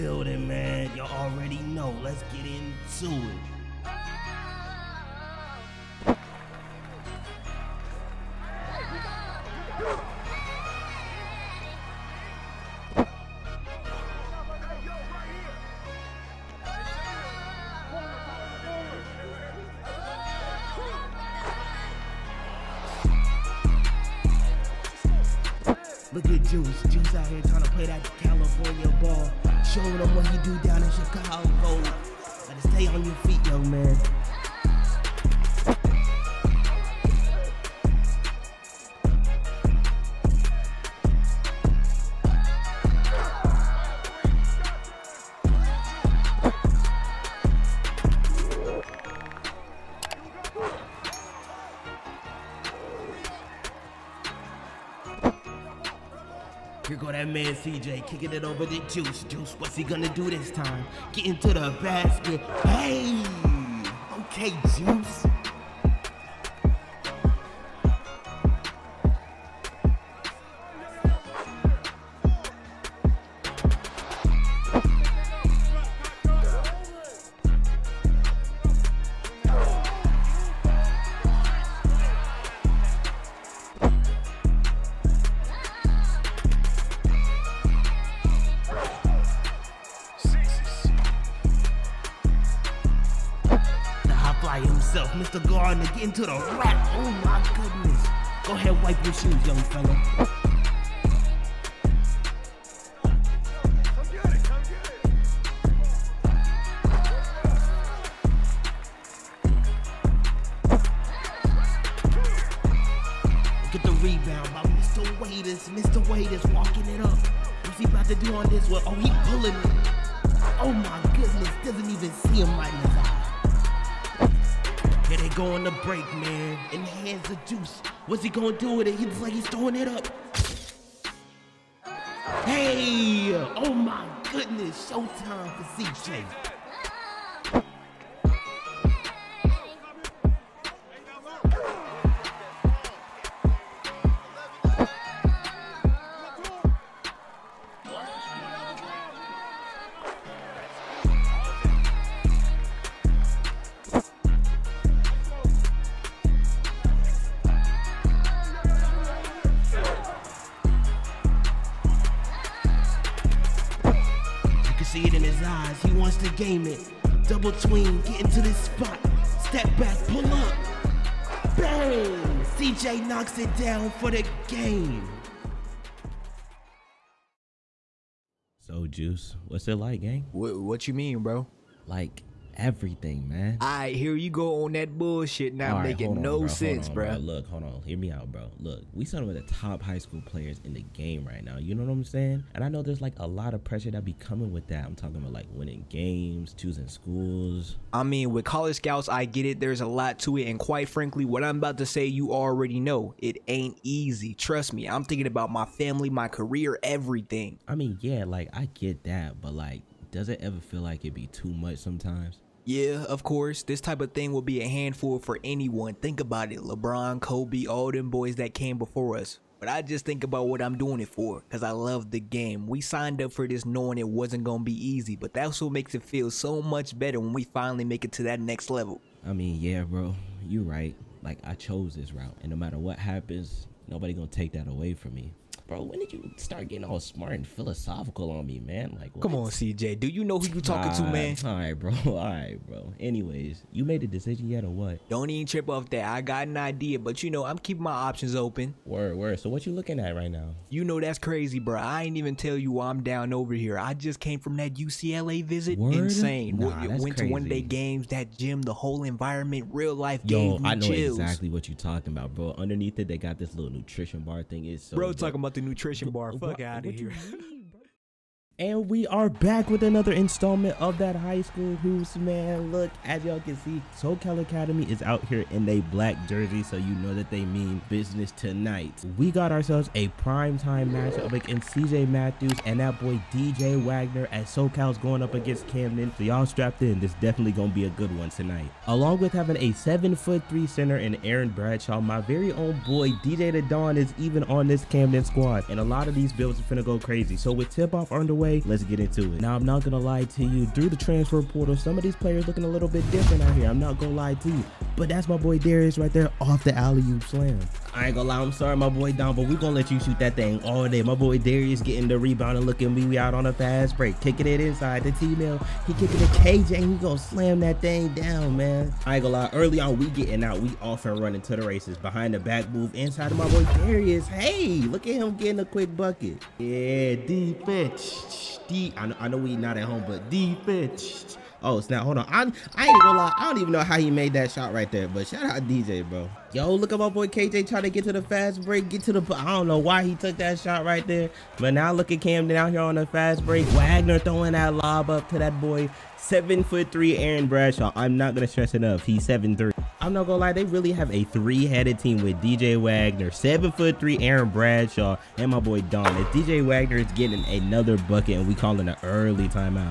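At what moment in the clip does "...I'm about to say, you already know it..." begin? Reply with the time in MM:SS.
03:21.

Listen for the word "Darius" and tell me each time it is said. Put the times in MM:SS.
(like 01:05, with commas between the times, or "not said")
05:05, 05:11, 05:23.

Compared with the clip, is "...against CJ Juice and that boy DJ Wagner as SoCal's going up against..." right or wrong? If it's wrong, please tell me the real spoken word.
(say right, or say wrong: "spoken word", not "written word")
wrong: "Matthews", not "Juice".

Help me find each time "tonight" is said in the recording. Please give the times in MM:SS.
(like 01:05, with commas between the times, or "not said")
04:38, 04:48.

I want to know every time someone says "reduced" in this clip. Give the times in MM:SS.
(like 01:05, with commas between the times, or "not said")
not said.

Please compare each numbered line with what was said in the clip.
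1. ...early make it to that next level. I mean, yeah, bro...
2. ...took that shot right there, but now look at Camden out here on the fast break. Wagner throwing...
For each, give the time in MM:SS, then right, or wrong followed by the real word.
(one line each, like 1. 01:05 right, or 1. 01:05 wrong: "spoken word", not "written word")
1. 03:47 wrong: "finally", not "early"
2. 05:40 right.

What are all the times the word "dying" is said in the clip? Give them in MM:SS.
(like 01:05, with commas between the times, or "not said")
not said.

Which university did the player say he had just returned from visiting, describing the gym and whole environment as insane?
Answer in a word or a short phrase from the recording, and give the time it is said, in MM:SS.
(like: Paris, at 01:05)
UCLA, at 04:14.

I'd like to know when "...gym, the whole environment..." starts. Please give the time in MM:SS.
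04:18.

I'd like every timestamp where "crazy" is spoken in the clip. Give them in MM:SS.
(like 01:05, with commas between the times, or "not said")
04:11, 04:17, 04:56.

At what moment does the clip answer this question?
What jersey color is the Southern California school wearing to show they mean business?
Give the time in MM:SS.
04:35.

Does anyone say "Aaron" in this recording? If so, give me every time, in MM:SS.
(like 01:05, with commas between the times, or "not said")
04:51, 05:47, 05:54.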